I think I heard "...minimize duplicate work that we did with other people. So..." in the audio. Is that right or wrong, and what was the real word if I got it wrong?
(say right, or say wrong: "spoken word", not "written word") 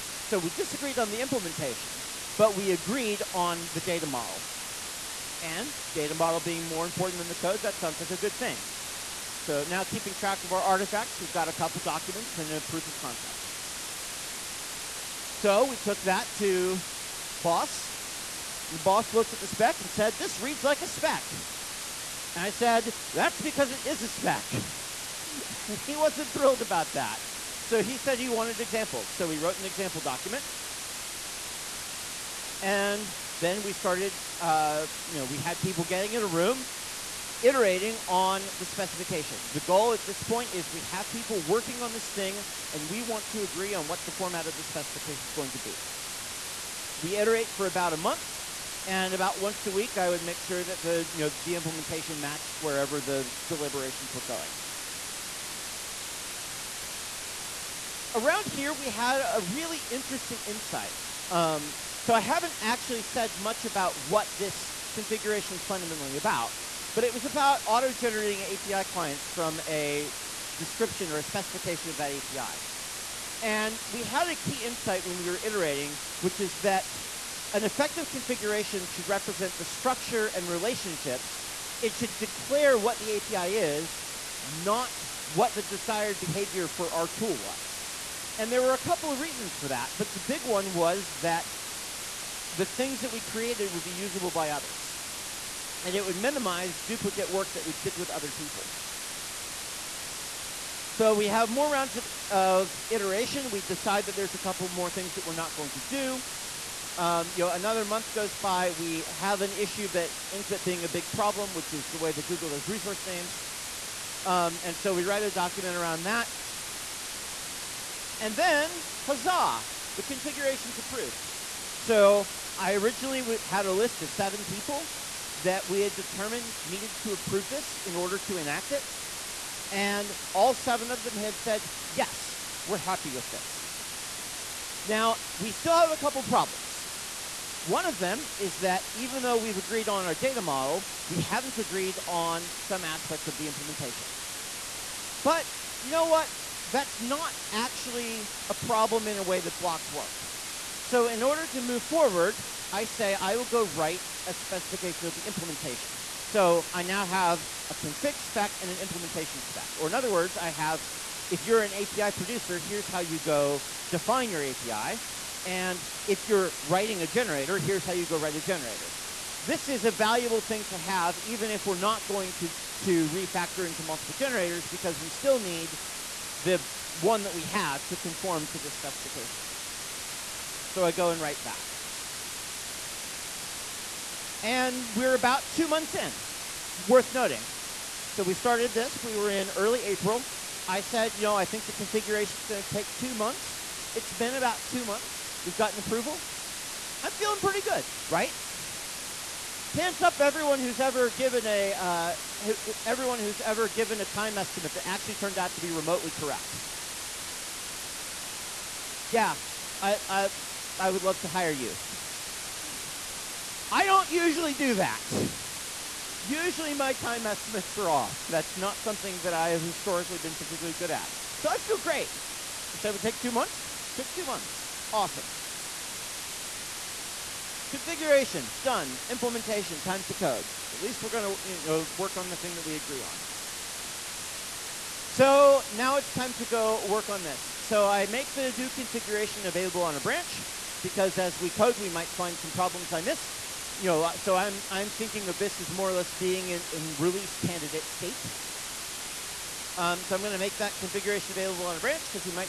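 right.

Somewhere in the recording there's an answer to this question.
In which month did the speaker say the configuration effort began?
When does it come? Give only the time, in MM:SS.
03:09.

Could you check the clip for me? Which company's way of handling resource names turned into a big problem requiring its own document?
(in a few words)
Google.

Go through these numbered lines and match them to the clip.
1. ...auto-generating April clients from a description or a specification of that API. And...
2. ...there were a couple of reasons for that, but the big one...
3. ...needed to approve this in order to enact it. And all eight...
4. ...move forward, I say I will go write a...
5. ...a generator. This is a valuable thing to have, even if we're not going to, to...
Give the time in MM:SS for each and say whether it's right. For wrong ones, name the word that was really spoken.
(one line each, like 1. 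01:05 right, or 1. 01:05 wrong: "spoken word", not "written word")
1. 01:07 wrong: "API", not "April"
2. 01:28 right
3. 02:06 wrong: "seven", not "eight"
4. 02:31 right
5. 02:48 right.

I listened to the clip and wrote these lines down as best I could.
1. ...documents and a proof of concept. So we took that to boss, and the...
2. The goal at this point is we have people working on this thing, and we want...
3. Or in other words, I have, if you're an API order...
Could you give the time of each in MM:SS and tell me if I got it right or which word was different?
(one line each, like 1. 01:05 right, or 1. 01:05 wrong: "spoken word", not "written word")
1. 00:11 right
2. 00:39 right
3. 02:39 wrong: "producer", not "order".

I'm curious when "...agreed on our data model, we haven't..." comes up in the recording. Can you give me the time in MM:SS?
02:19.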